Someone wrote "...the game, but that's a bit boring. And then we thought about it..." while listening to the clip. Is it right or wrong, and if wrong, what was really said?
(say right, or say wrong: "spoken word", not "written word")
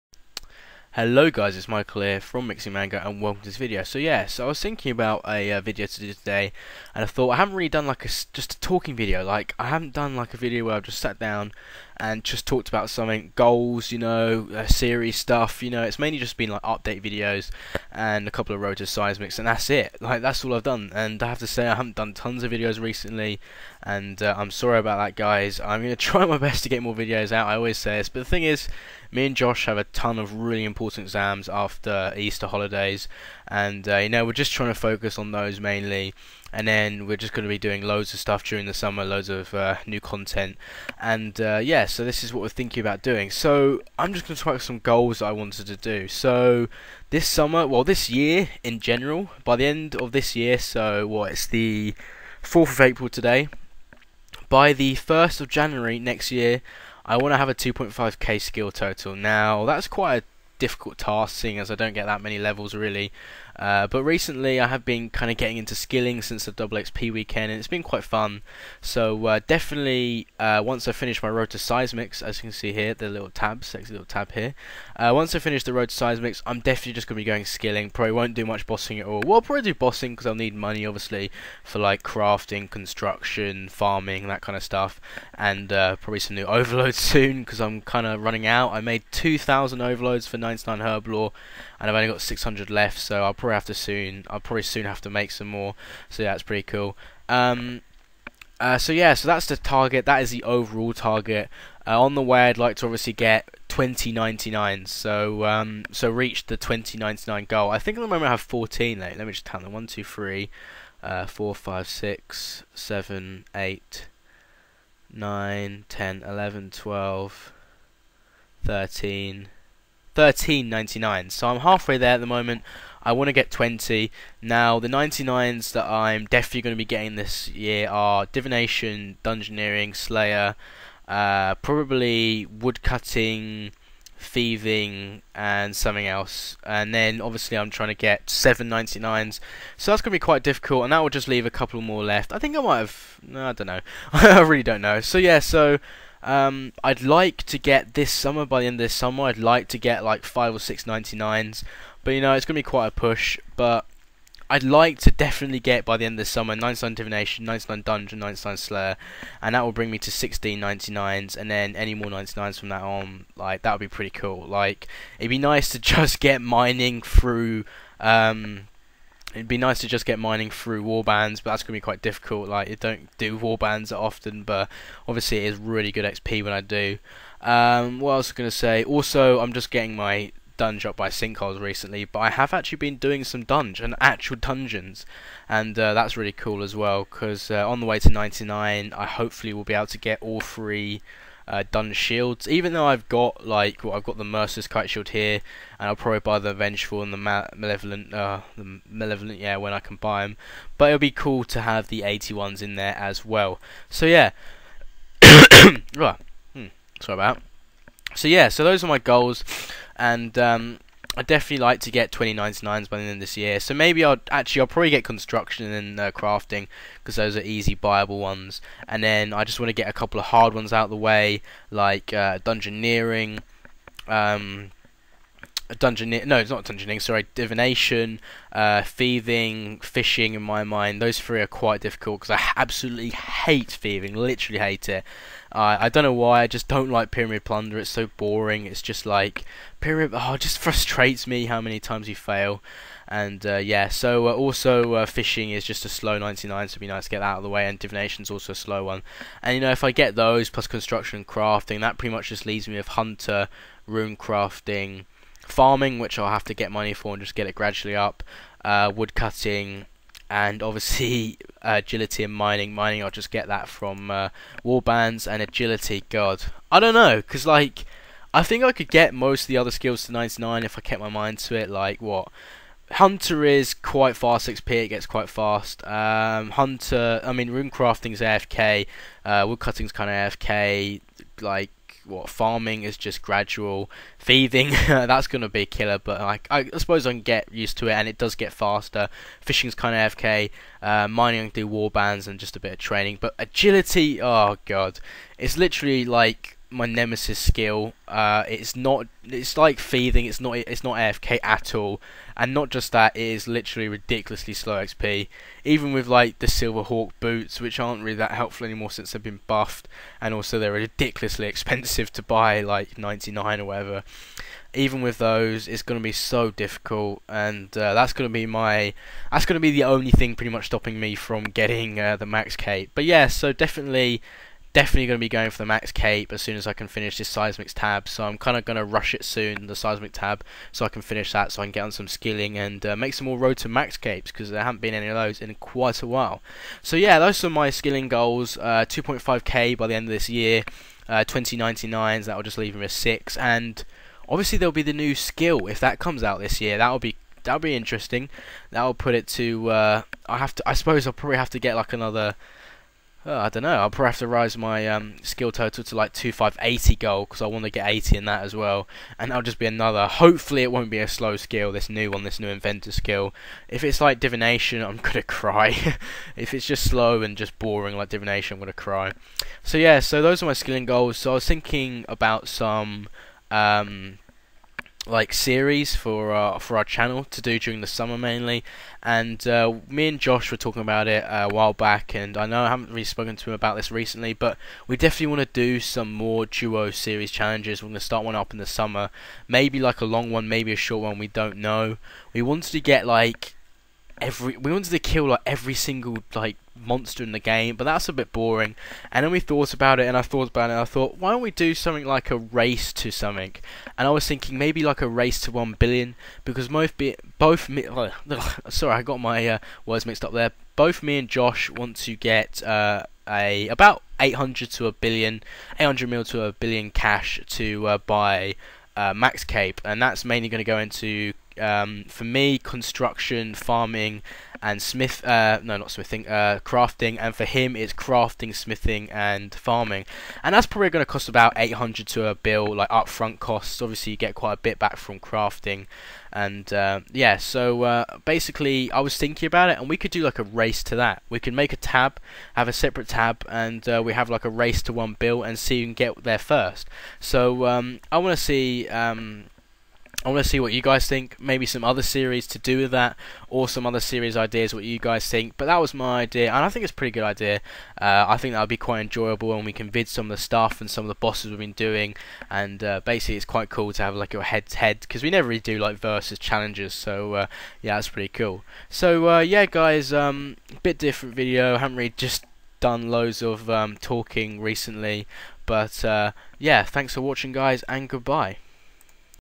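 right.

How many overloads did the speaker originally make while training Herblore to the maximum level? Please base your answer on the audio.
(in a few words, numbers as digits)
2,000.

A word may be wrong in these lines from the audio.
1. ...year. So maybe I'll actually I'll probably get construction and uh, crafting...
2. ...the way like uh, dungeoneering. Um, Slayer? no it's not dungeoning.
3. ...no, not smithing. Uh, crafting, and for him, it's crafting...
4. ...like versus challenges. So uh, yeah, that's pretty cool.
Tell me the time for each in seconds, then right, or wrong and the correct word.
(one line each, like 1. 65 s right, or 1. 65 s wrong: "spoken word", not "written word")
1. 213 s right
2. 220 s wrong: "Dungeoning", not "Slayer"
3. 425 s right
4. 465 s right.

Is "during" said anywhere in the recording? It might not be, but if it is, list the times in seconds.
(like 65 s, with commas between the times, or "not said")
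38 s, 377 s.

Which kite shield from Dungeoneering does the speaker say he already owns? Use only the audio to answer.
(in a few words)
Merciless.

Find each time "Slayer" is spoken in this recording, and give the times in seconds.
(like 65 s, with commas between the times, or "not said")
129 s, 158 s.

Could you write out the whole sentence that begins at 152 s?
But you know, it's going to be quite a push.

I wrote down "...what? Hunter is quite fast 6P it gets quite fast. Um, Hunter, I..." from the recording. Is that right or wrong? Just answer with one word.
right.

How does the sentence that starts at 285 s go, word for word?
But like I, suppose I can get used to it, and it does get faster.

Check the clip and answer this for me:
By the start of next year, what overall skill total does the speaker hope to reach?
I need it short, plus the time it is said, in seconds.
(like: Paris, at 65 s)
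2.5k, at 57 s.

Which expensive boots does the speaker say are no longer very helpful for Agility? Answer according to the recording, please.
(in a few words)
Silverhawk boots.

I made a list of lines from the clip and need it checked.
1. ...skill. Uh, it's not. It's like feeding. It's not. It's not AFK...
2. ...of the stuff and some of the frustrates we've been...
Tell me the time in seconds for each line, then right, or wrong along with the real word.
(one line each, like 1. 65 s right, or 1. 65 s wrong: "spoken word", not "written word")
1. 297 s right
2. 460 s wrong: "bosses", not "frustrates".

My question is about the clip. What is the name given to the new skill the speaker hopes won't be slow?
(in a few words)
inventor.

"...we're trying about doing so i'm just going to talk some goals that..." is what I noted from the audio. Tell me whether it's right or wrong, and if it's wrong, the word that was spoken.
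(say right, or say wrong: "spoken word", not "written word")
wrong: "thinking", not "trying".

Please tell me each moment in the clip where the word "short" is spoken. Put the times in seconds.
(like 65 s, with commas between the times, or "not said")
390 s.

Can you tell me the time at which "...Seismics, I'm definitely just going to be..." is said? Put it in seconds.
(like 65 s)
75 s.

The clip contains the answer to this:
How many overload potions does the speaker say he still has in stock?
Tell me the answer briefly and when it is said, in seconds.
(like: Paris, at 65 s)
600, at 92 s.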